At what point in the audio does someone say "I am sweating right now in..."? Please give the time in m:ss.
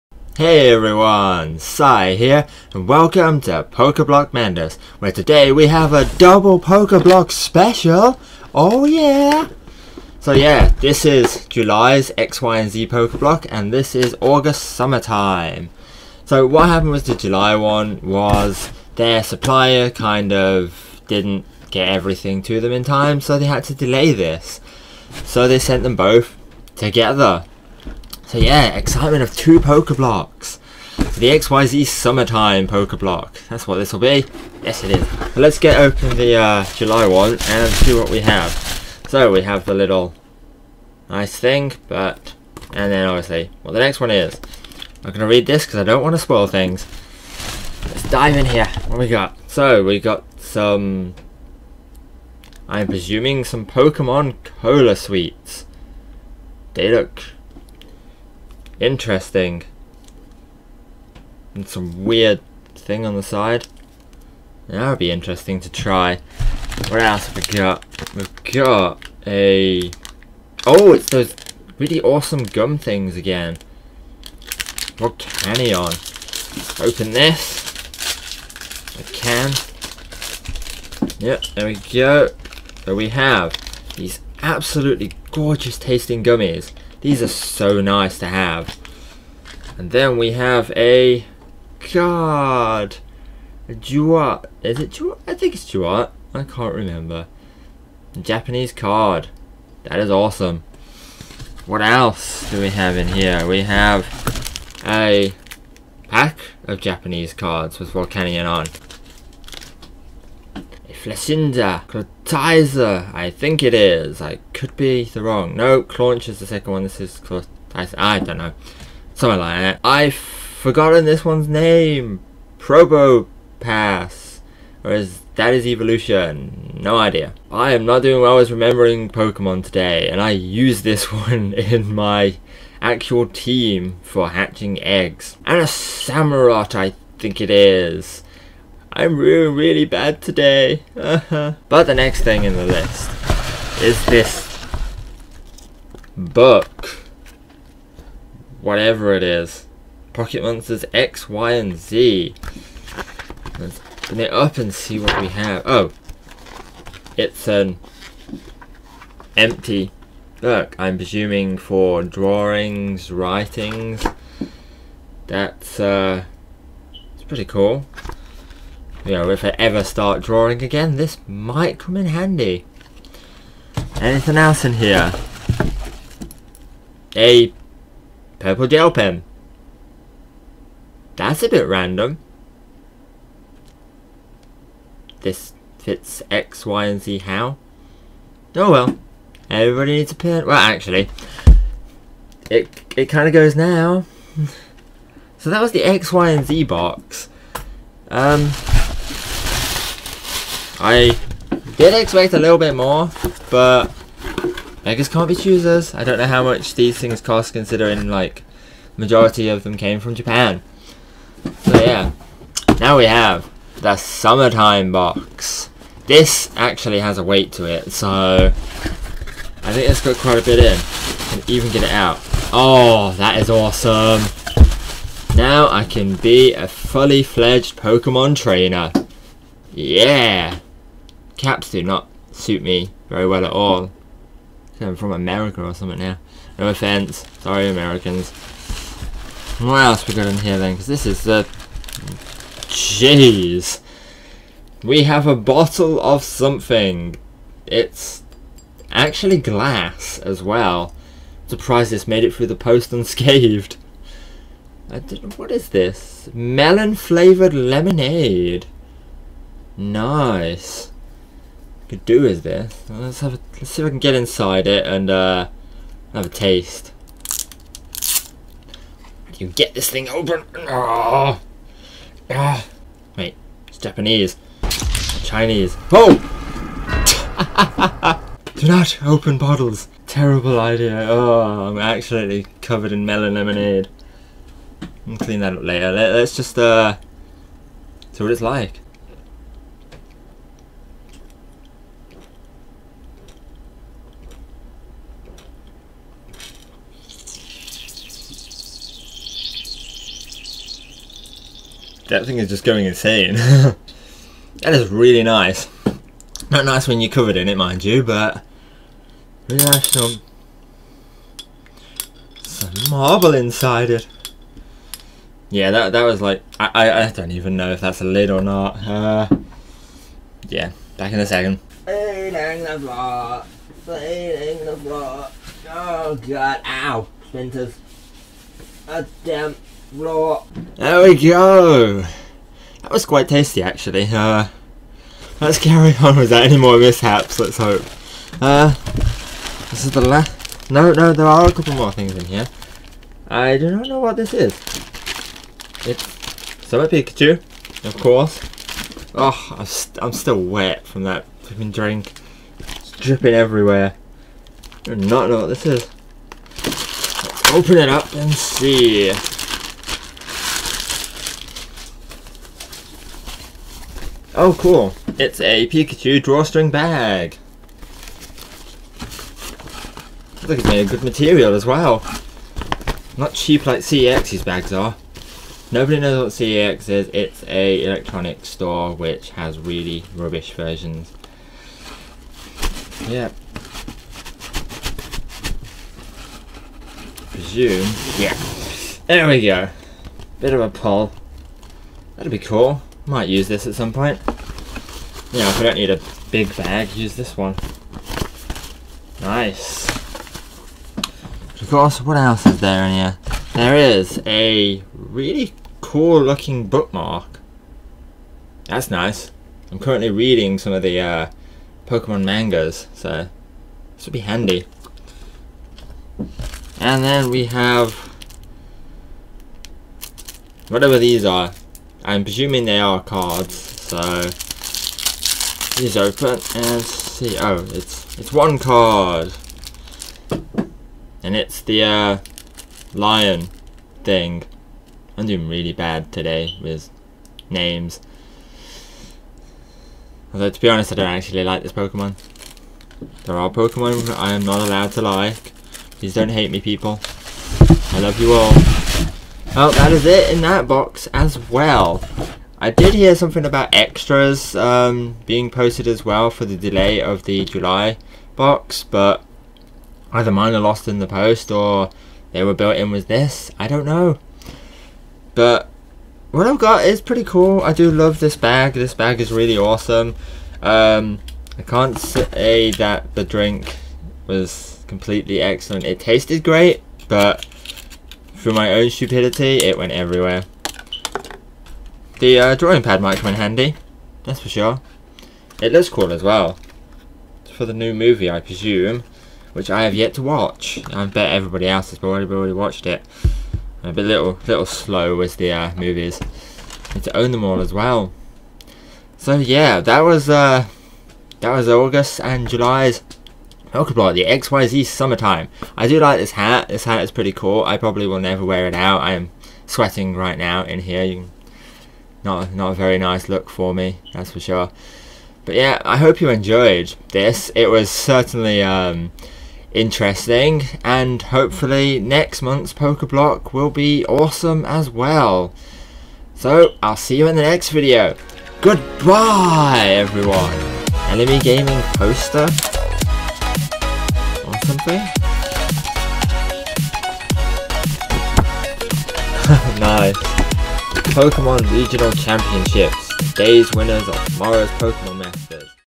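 8:29.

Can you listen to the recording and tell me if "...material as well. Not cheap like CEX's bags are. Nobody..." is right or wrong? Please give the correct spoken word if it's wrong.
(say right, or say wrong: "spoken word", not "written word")
right.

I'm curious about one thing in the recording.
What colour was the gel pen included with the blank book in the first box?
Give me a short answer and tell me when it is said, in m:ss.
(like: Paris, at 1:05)
Purple, at 2:58.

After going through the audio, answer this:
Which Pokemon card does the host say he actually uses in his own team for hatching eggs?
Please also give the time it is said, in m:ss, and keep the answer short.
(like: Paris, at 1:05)
Probopass, at 2:02.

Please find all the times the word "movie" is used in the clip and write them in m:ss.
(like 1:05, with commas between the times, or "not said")
8:07, 8:15.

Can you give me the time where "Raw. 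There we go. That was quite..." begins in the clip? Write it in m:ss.
5:29.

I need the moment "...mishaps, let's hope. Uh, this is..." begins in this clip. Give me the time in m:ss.
5:36.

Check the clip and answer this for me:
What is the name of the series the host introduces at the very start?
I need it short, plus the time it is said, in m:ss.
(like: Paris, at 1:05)
Pokeblock Madness, at 0:03.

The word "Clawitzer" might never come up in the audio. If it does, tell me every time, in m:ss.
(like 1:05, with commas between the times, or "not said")
1:51, 1:57.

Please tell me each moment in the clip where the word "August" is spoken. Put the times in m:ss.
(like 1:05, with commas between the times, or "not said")
0:14, 8:21.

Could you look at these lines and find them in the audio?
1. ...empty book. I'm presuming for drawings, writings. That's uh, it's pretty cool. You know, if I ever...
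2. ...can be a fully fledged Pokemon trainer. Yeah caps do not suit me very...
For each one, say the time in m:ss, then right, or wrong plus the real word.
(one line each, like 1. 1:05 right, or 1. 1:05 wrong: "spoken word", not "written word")
1. 2:39 right
2. 3:45 right.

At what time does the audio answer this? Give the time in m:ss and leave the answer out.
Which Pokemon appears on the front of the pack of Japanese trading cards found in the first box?
1:47.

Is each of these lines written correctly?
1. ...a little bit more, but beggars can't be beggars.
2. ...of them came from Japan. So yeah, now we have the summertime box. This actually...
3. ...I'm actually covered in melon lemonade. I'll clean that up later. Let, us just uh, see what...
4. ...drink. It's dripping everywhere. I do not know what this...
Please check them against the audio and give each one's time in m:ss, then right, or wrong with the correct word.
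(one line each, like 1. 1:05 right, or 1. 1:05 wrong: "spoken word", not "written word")
1. 3:22 wrong: "choosers", not "beggars"
2. 3:29 right
3. 4:41 right
4. 5:51 right.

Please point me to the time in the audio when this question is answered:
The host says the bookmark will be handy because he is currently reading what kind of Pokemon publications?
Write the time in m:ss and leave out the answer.
6:52.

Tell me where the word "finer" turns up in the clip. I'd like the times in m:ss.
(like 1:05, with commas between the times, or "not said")
not said.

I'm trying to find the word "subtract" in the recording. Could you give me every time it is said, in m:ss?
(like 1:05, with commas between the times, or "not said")
not said.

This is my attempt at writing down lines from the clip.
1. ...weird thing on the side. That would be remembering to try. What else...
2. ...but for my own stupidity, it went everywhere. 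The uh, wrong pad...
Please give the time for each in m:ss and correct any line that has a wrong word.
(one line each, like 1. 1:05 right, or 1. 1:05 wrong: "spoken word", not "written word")
1. 1:02 wrong: "interesting", not "remembering"
2. 7:57 wrong: "drawing", not "wrong".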